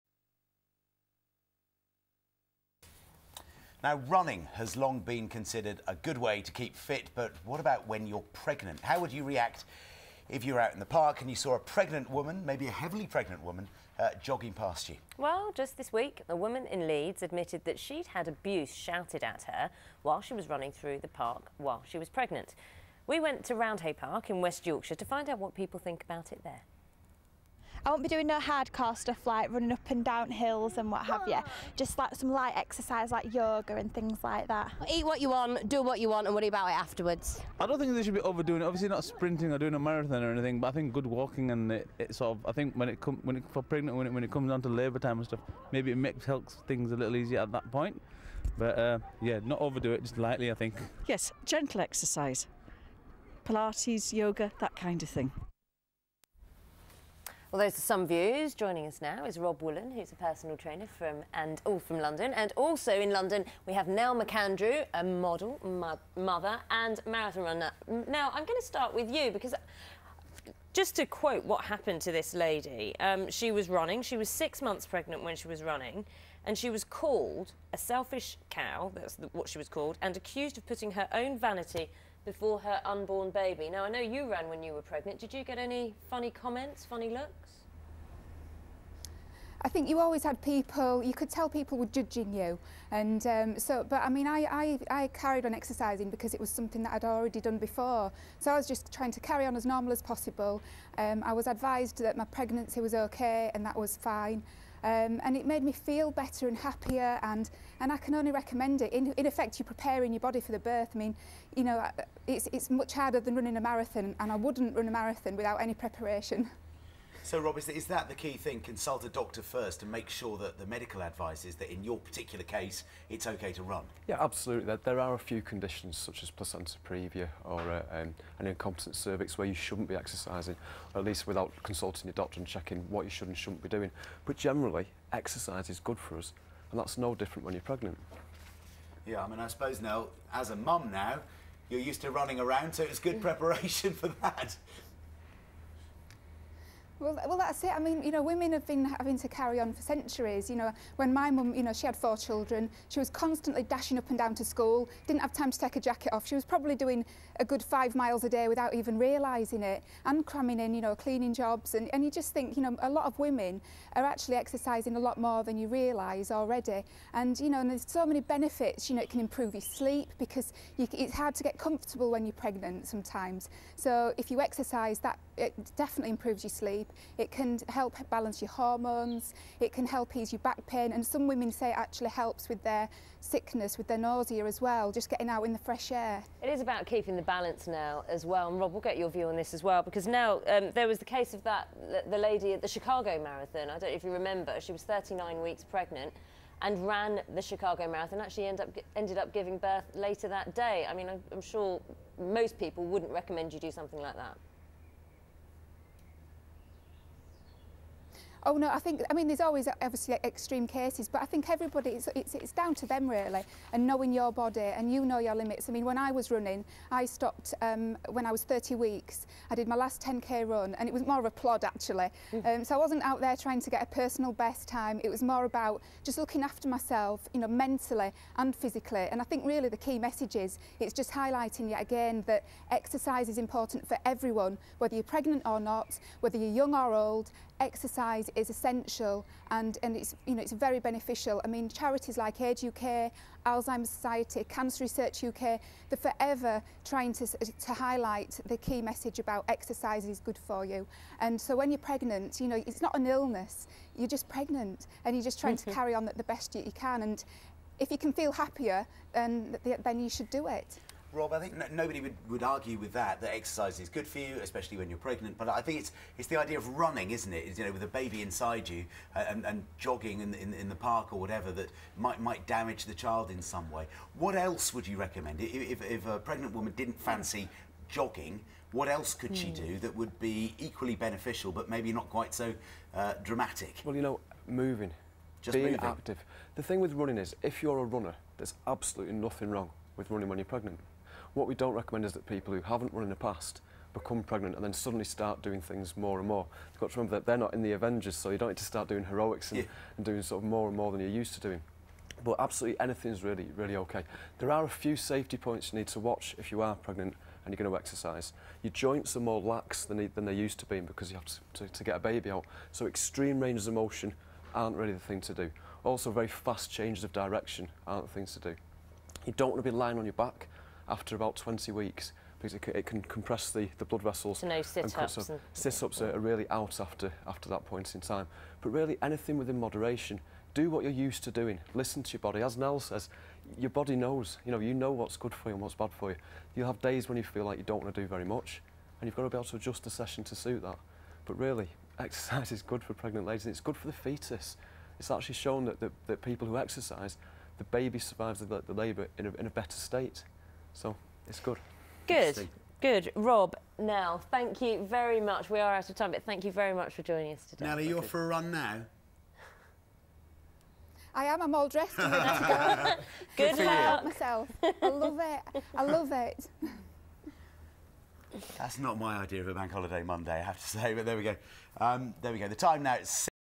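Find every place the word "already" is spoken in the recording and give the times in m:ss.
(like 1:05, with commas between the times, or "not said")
1:37, 2:46.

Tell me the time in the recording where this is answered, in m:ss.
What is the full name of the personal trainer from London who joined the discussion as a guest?
0:59.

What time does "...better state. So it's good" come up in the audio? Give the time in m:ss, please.
5:49.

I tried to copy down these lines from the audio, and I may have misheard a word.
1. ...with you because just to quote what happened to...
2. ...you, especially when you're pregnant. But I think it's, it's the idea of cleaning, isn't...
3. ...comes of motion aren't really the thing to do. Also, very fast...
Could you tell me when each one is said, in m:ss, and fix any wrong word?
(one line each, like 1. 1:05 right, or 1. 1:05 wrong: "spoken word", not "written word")
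1. 1:08 right
2. 4:24 wrong: "running", not "cleaning"
3. 5:13 wrong: "ranges", not "comes".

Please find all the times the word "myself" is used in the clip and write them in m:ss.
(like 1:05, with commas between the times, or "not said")
3:46, 6:04.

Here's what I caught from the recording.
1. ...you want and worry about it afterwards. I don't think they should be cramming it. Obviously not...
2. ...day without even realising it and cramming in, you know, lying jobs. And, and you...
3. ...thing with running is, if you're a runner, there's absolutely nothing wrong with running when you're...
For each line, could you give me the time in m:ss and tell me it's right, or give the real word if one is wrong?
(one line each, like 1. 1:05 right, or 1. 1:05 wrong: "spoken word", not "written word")
1. 0:35 wrong: "overdoing", not "cramming"
2. 2:38 wrong: "cleaning", not "lying"
3. 4:46 right.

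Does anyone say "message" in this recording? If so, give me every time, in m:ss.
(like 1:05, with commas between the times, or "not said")
3:49, 4:08.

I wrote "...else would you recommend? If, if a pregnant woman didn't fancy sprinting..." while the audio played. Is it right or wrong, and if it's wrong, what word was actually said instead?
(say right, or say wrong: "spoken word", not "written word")
wrong: "jogging", not "sprinting".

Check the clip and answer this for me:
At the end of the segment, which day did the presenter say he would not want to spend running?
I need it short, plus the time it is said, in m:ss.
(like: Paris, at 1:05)
Bank holiday Monday, at 6:09.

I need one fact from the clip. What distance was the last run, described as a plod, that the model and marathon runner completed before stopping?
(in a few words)
10k.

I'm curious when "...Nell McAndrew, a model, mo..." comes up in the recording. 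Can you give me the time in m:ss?
1:03.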